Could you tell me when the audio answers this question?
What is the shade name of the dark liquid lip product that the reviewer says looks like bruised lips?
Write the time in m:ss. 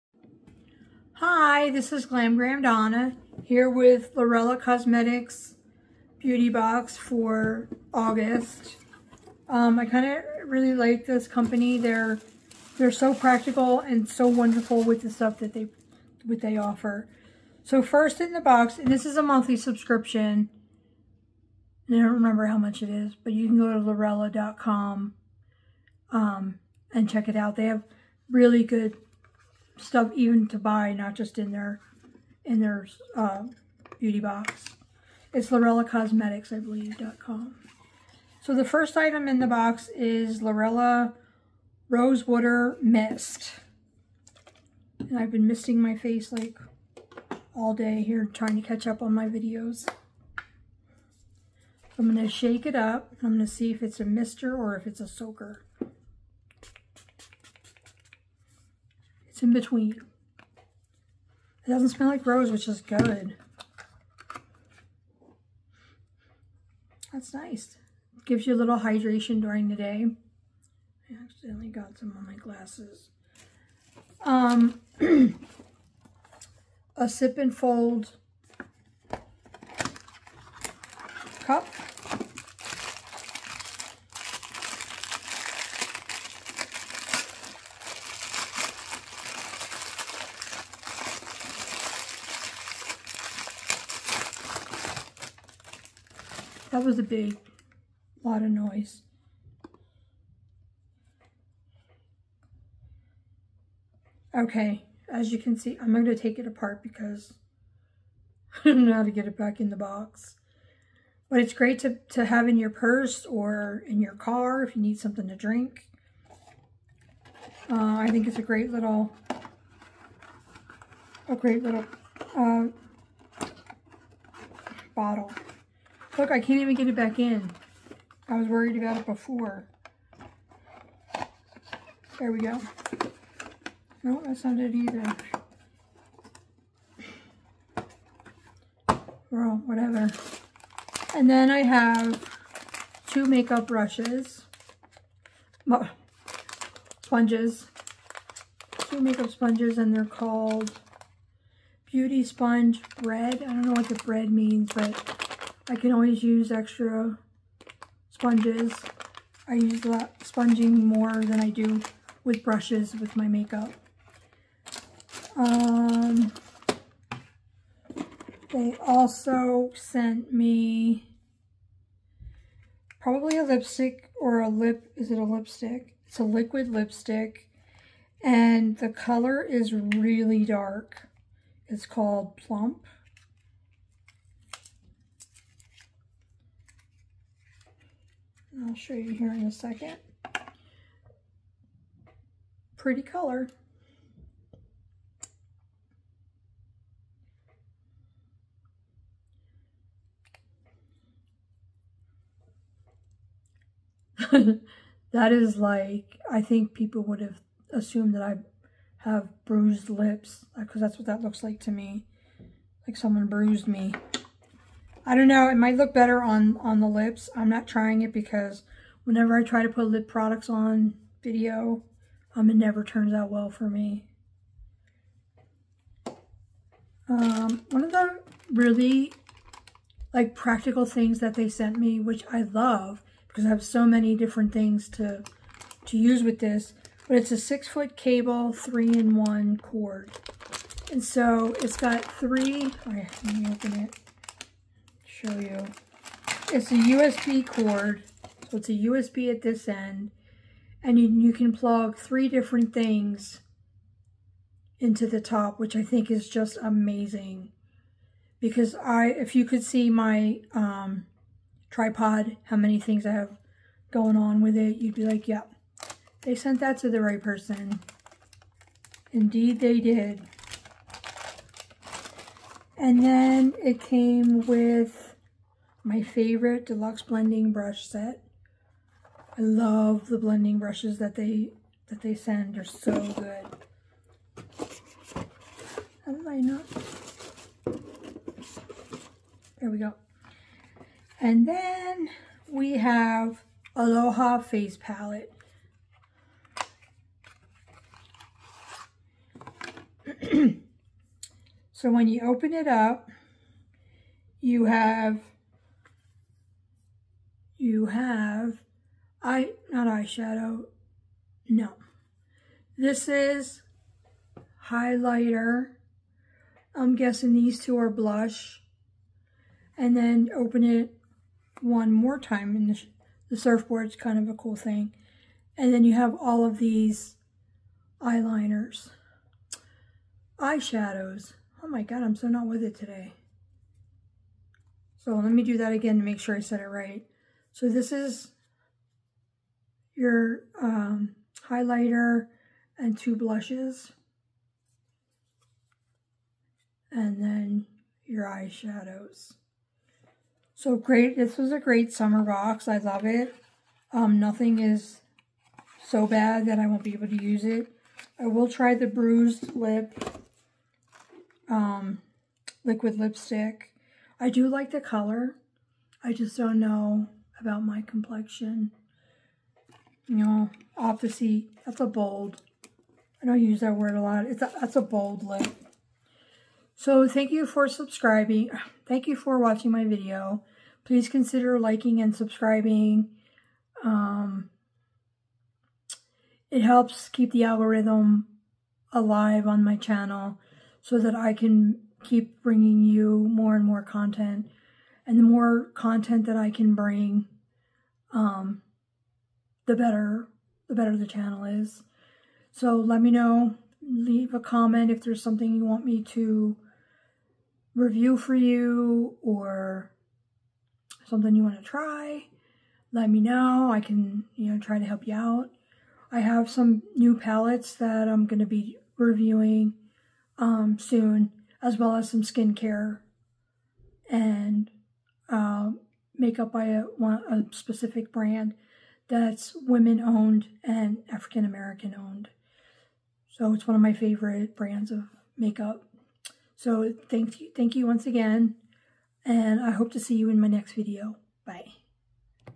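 3:02.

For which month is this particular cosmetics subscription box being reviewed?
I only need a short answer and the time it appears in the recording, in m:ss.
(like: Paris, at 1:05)
August, at 0:07.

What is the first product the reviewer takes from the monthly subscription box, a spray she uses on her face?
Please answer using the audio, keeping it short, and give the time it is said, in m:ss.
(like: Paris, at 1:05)
Lurella Rosewater Mist, at 0:40.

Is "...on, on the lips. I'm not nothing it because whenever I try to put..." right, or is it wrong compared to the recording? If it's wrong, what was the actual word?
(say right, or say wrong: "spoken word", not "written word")
wrong: "trying", not "nothing".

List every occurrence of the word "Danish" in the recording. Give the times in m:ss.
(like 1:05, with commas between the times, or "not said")
not said.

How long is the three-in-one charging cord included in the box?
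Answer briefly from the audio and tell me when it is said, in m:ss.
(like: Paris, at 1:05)
6 feet, at 3:57.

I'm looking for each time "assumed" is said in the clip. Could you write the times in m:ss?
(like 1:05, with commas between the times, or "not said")
3:27.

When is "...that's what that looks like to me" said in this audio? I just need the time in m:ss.
3:30.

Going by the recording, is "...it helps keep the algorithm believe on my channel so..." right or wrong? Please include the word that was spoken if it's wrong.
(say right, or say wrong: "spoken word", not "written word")
wrong: "alive", not "believe".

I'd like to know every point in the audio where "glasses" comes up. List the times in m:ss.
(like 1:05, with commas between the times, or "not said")
1:12.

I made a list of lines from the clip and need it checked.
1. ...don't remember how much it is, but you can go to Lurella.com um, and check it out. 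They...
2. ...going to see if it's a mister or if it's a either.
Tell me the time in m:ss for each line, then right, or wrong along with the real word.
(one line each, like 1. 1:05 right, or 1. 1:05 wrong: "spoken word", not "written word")
1. 0:21 right
2. 0:53 wrong: "soaker", not "either".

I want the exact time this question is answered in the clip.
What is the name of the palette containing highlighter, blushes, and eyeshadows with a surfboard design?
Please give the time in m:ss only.
4:53.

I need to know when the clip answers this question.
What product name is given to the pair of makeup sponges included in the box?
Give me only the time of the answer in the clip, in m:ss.
2:31.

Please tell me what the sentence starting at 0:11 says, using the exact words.
They're they're so practical and so wonderful with the stuff that they what they offer.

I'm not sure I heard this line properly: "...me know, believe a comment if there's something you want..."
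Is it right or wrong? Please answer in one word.
wrong.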